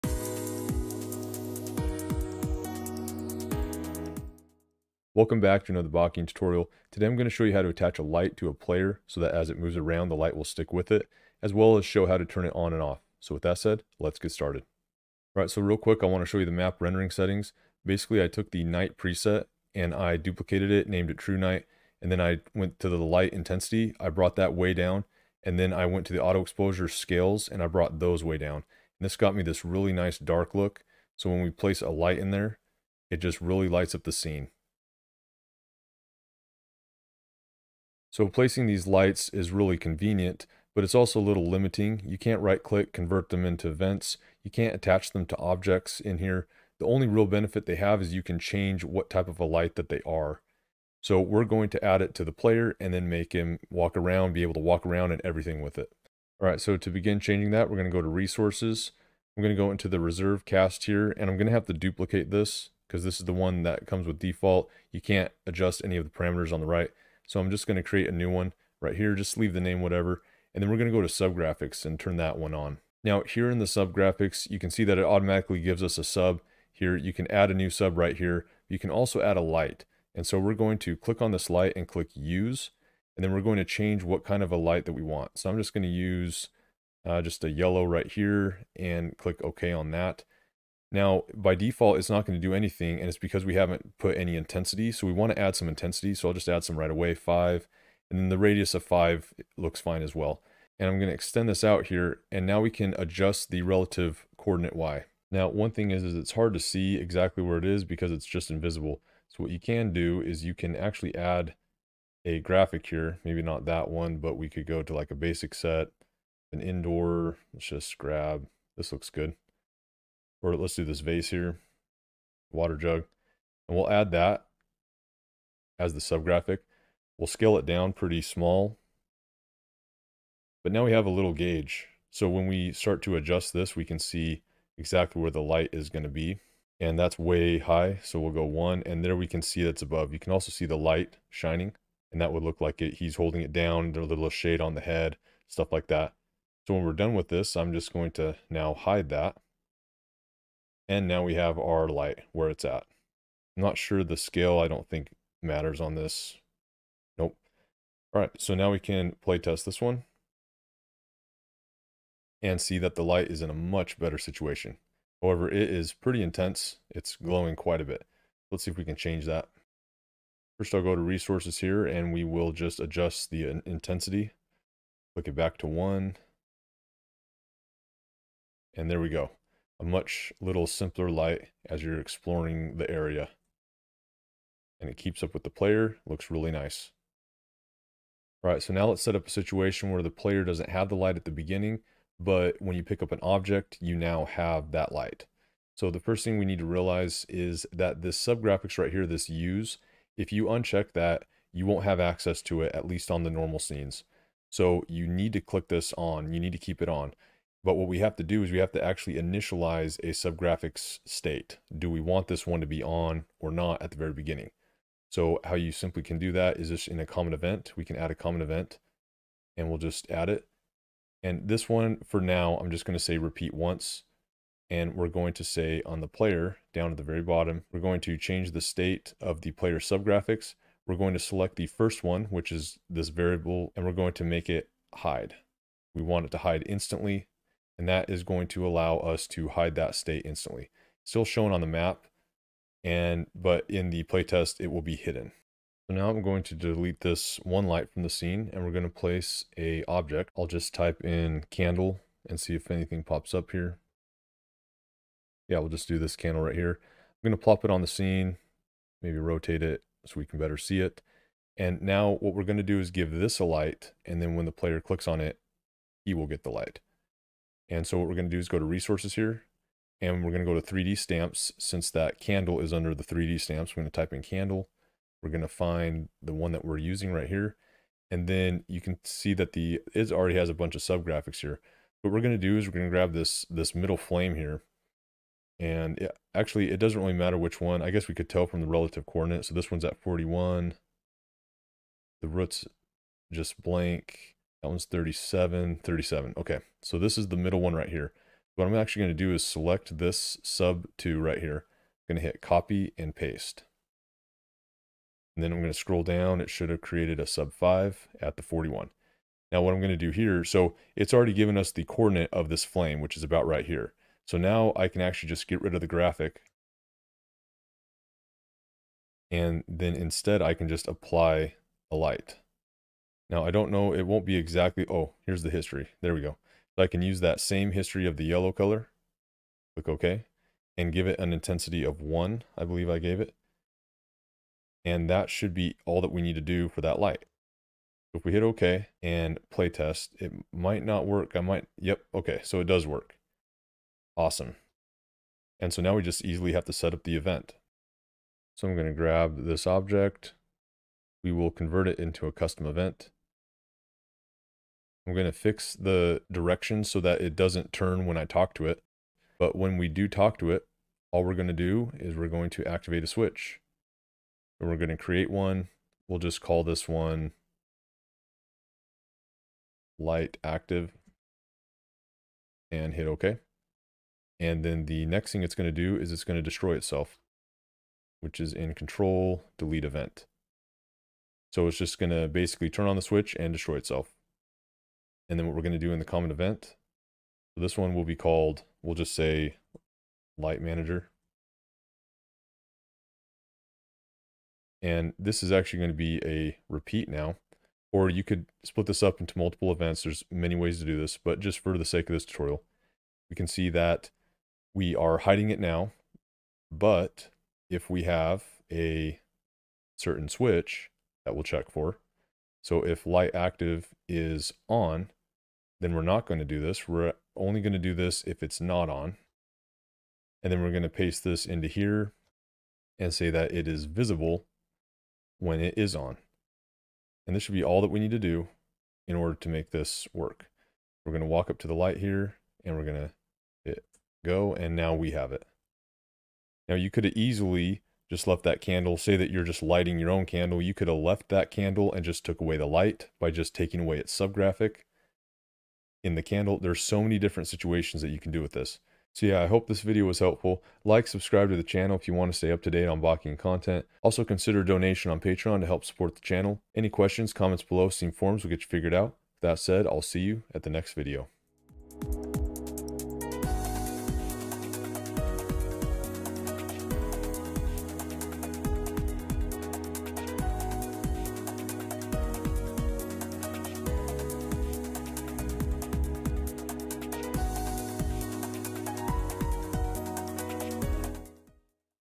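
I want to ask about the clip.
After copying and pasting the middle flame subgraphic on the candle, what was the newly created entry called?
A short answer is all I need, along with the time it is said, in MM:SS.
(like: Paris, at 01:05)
sub 5, at 05:07.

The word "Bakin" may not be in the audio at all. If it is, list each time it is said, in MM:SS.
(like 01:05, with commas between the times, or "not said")
00:05, 07:33.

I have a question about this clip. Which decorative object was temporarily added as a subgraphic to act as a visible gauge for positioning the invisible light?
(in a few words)
water jug.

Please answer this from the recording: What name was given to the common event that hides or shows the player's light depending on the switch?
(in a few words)
light manager.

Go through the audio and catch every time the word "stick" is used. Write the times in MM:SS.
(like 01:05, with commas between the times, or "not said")
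00:10.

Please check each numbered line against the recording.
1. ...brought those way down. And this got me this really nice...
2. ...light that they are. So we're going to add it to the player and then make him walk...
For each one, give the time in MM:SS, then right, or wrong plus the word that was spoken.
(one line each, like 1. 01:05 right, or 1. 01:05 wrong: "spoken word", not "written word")
1. 00:27 right
2. 00:49 right.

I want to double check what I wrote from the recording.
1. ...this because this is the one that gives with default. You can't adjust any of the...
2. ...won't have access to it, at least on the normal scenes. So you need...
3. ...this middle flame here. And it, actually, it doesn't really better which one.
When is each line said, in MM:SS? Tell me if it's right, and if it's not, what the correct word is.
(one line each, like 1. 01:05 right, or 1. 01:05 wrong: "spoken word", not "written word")
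1. 01:02 wrong: "comes", not "gives"
2. 03:21 right
3. 04:43 wrong: "matter", not "better".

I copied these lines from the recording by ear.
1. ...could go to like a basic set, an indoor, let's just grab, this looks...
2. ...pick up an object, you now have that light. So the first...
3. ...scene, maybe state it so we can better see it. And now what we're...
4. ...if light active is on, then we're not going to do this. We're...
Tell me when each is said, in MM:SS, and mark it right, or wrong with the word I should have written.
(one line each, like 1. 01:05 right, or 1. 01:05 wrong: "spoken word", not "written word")
1. 01:54 right
2. 03:12 right
3. 04:17 wrong: "rotate", not "state"
4. 06:52 right.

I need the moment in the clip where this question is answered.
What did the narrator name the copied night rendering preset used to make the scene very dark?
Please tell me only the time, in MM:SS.
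00:21.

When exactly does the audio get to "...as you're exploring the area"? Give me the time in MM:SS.
03:01.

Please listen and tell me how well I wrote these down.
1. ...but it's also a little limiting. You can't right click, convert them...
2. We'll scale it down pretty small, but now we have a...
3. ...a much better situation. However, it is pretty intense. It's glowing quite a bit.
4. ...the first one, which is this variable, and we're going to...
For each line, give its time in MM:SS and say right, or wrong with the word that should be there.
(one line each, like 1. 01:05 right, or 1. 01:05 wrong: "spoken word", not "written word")
1. 00:40 right
2. 02:07 right
3. 02:43 right
4. 03:51 right.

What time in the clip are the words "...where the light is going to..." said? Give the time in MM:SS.
02:15.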